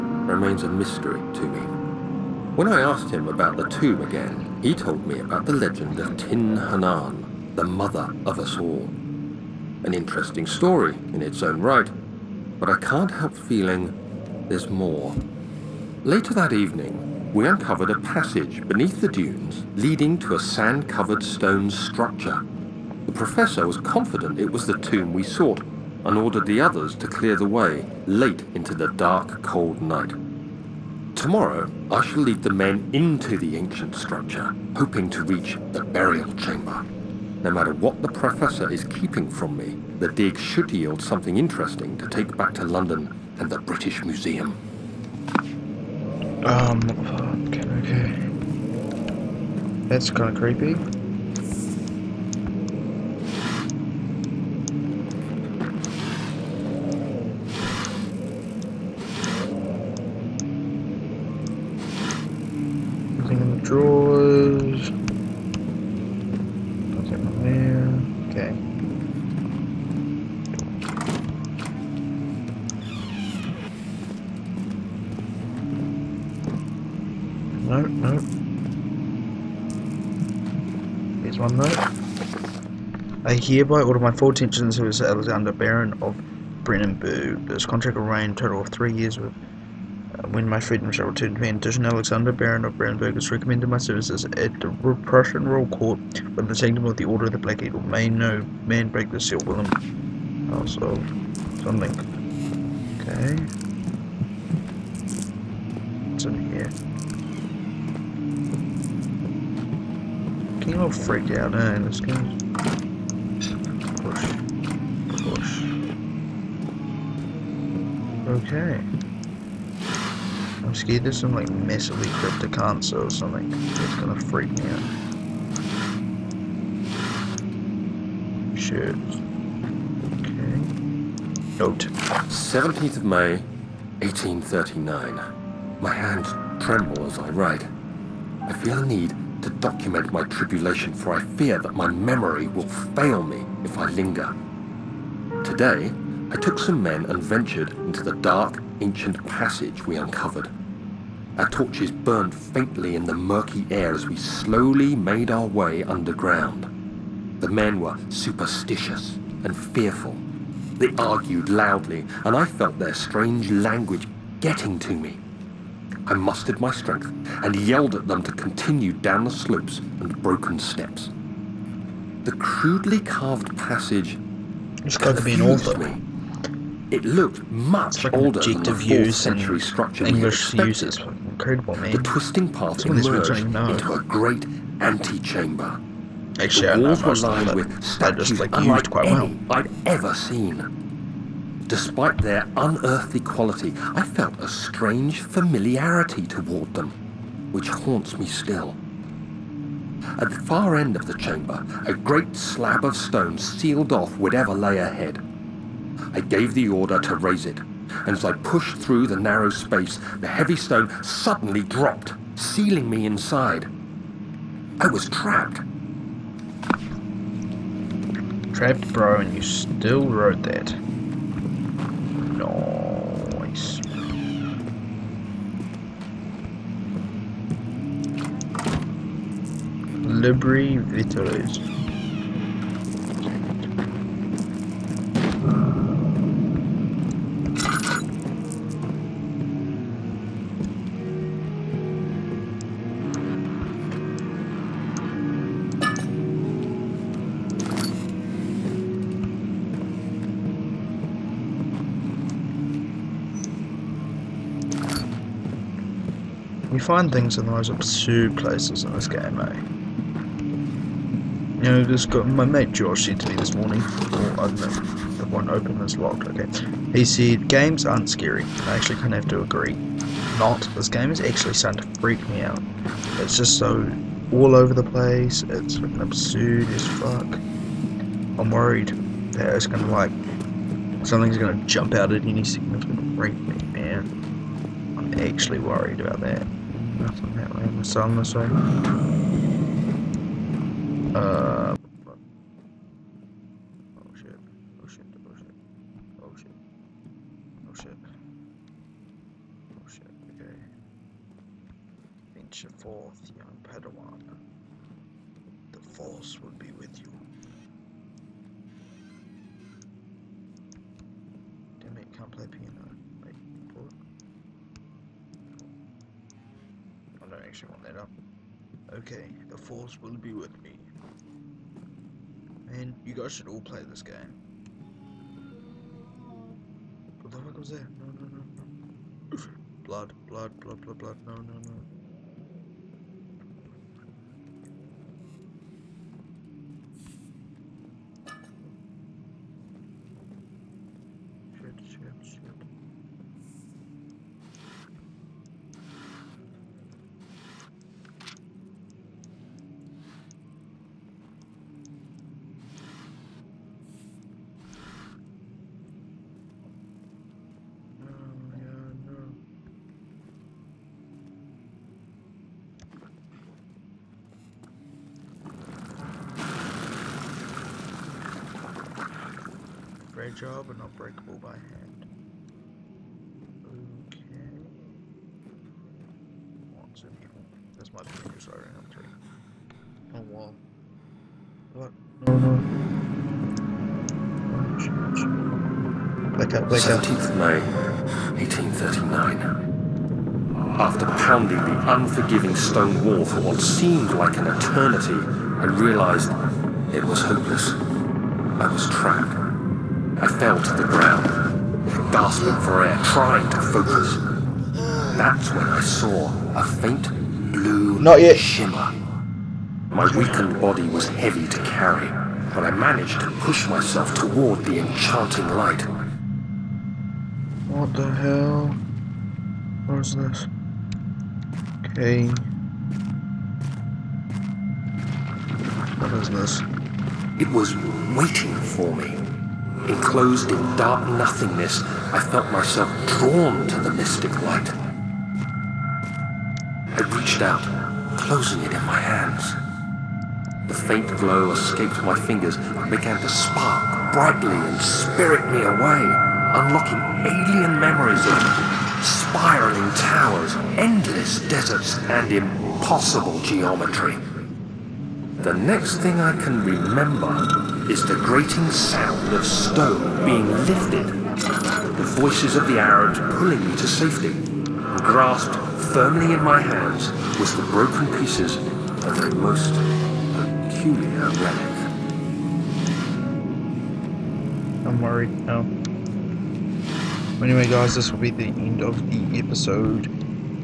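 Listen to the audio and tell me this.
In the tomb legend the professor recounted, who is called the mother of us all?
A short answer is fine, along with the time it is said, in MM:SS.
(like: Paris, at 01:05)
Tin Hinan, at 00:06.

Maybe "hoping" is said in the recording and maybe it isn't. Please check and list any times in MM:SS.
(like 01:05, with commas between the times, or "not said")
00:34.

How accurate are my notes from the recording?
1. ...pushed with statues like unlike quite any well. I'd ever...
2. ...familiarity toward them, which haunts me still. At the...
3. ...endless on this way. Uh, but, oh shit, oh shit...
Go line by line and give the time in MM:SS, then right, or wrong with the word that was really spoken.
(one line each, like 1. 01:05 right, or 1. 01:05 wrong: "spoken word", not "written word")
1. 03:07 wrong: "lined", not "pushed"
2. 03:15 right
3. 04:47 wrong: "unless", not "endless".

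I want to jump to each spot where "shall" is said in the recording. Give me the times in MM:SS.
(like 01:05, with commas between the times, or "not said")
00:32, 01:30.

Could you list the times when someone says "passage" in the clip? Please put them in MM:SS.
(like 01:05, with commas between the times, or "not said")
00:17, 02:29, 02:53.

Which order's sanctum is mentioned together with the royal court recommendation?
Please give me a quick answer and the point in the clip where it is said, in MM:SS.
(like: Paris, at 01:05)
Order of the Black Eagle, at 01:37.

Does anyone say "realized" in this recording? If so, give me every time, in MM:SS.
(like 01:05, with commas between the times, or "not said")
06:35.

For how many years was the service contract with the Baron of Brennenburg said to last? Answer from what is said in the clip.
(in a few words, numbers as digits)
3.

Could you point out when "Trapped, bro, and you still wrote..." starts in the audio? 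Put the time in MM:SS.
03:38.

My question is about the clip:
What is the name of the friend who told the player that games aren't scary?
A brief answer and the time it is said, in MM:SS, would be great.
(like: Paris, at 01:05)
George, at 04:22.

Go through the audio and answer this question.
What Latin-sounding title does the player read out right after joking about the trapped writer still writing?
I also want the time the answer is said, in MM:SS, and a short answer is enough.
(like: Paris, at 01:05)
Libri Vitalis, at 03:50.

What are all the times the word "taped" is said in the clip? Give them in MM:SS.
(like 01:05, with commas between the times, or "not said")
not said.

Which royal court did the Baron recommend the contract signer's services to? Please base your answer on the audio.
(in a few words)
Prussian Royal Court.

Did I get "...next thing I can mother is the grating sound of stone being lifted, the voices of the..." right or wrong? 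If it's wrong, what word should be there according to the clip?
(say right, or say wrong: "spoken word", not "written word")
wrong: "remember", not "mother".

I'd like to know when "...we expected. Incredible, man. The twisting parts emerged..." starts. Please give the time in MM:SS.
03:00.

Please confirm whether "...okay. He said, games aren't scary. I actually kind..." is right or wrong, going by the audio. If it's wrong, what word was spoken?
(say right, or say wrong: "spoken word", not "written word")
right.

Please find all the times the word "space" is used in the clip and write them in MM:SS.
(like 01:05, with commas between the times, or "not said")
03:29.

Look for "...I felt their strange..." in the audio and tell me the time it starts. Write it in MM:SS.
02:42.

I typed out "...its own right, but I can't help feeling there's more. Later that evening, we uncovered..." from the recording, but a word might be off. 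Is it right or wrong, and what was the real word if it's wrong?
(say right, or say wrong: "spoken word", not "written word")
right.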